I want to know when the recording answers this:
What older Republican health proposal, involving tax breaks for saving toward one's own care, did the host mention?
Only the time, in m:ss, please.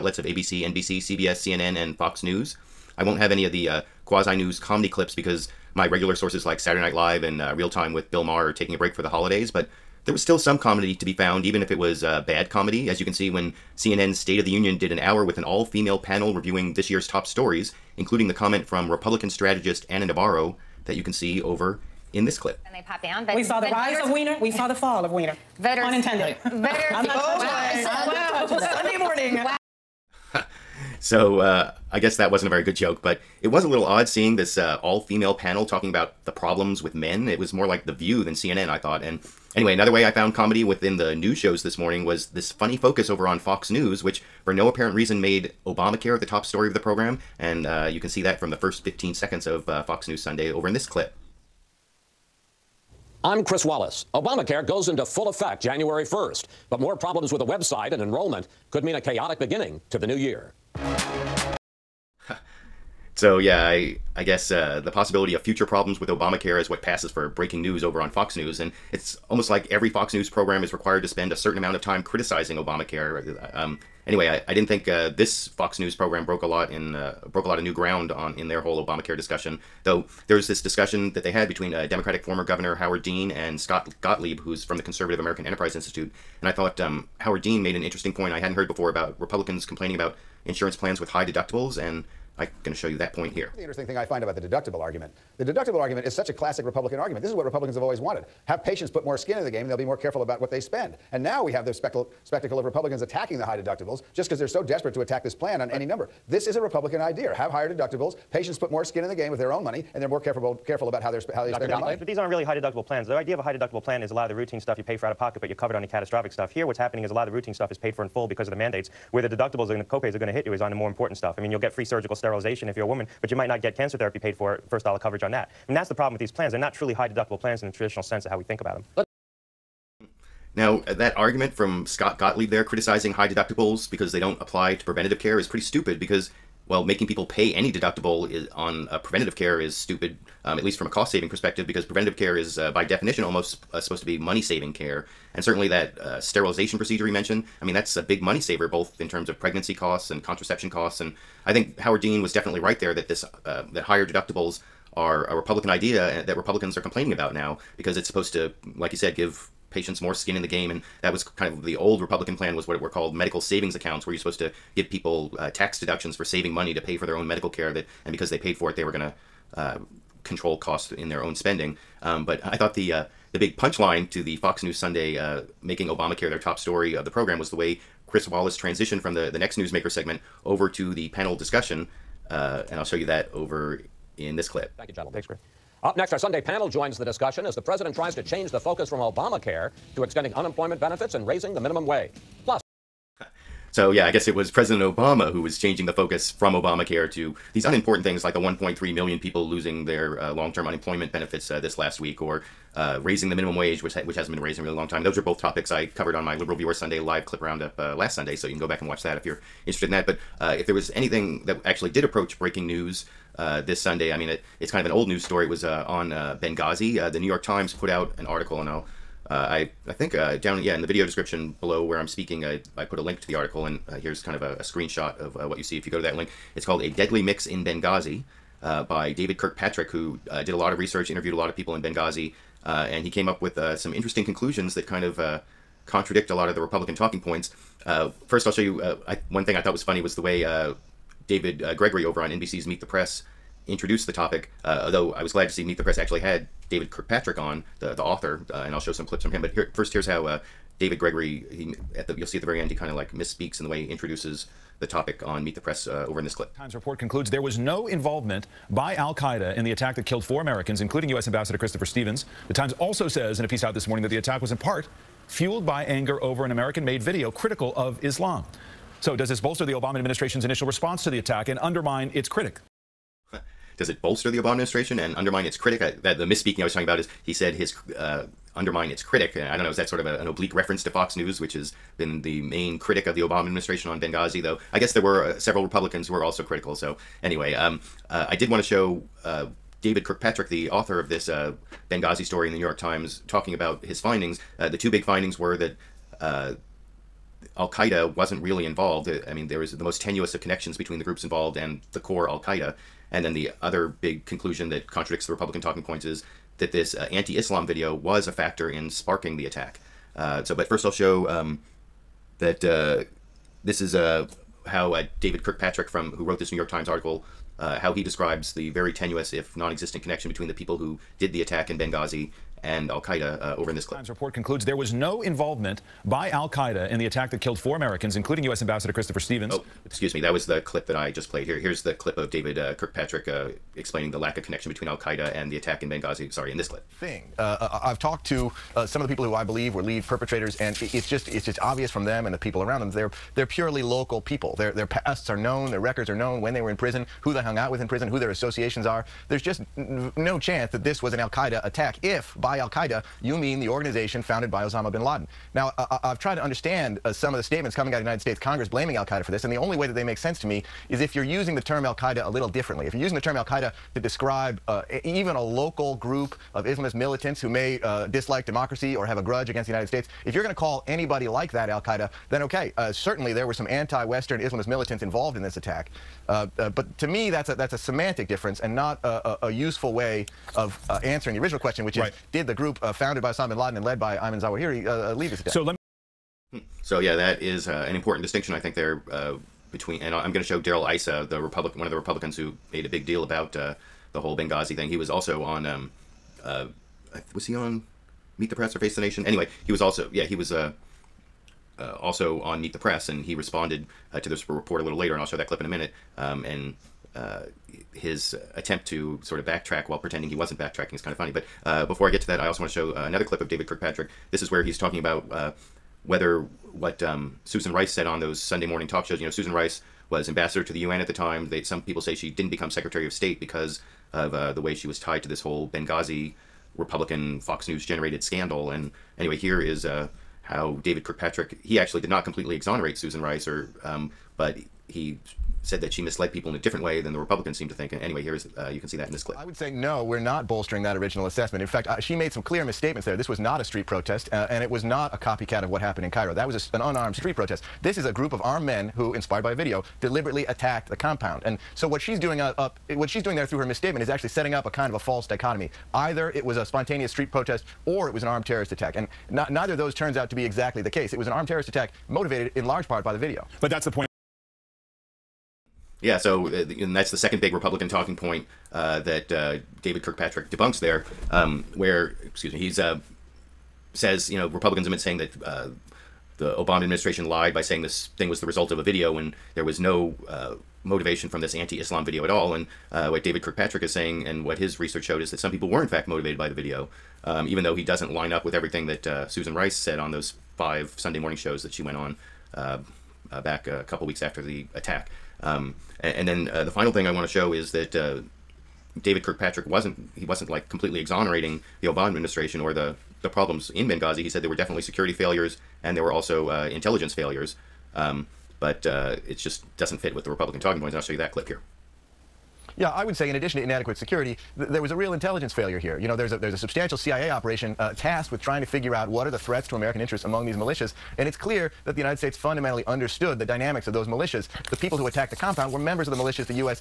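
2:43.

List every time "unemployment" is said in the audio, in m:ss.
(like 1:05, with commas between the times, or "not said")
3:10, 3:20.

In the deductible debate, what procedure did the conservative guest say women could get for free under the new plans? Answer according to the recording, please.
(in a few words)
surgical sterilization.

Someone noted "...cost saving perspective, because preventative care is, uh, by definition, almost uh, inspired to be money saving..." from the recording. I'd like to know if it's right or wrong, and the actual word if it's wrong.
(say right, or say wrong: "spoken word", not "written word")
wrong: "supposed", not "inspired".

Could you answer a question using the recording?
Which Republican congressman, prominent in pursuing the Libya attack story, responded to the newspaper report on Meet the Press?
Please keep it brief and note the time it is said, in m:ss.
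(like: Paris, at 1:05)
Darrell Issa, at 6:30.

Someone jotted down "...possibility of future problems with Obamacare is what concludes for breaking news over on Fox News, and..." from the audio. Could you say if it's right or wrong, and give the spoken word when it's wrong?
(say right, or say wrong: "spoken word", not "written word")
wrong: "passes", not "concludes".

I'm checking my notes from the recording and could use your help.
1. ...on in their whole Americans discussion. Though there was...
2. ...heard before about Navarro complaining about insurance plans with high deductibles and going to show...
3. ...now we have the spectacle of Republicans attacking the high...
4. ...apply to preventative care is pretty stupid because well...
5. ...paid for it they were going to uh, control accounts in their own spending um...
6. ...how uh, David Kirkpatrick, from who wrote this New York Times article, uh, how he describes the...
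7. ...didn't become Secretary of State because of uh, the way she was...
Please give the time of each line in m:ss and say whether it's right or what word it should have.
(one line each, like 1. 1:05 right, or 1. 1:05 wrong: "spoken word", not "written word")
1. 1:18 wrong: "Obamacare", not "Americans"
2. 1:28 wrong: "Republicans", not "Navarro"
3. 1:41 right
4. 2:14 right
5. 2:48 wrong: "costs", not "accounts"
6. 5:14 right
7. 7:02 right.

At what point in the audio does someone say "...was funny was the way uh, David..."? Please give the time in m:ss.
3:59.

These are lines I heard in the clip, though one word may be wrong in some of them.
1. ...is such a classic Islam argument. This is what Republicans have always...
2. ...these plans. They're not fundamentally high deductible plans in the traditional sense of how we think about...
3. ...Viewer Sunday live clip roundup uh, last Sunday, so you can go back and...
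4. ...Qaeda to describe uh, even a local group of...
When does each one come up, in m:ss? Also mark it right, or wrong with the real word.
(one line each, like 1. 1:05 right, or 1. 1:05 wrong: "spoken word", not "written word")
1. 1:36 wrong: "Republican", not "Islam"
2. 2:06 wrong: "truly", not "fundamentally"
3. 3:26 right
4. 6:03 right.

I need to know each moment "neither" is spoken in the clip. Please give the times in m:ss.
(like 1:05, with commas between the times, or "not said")
7:39.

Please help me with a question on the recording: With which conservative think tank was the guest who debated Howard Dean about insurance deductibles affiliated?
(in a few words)
American Enterprise Institute.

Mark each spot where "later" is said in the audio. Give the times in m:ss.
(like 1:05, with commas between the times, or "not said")
6:44.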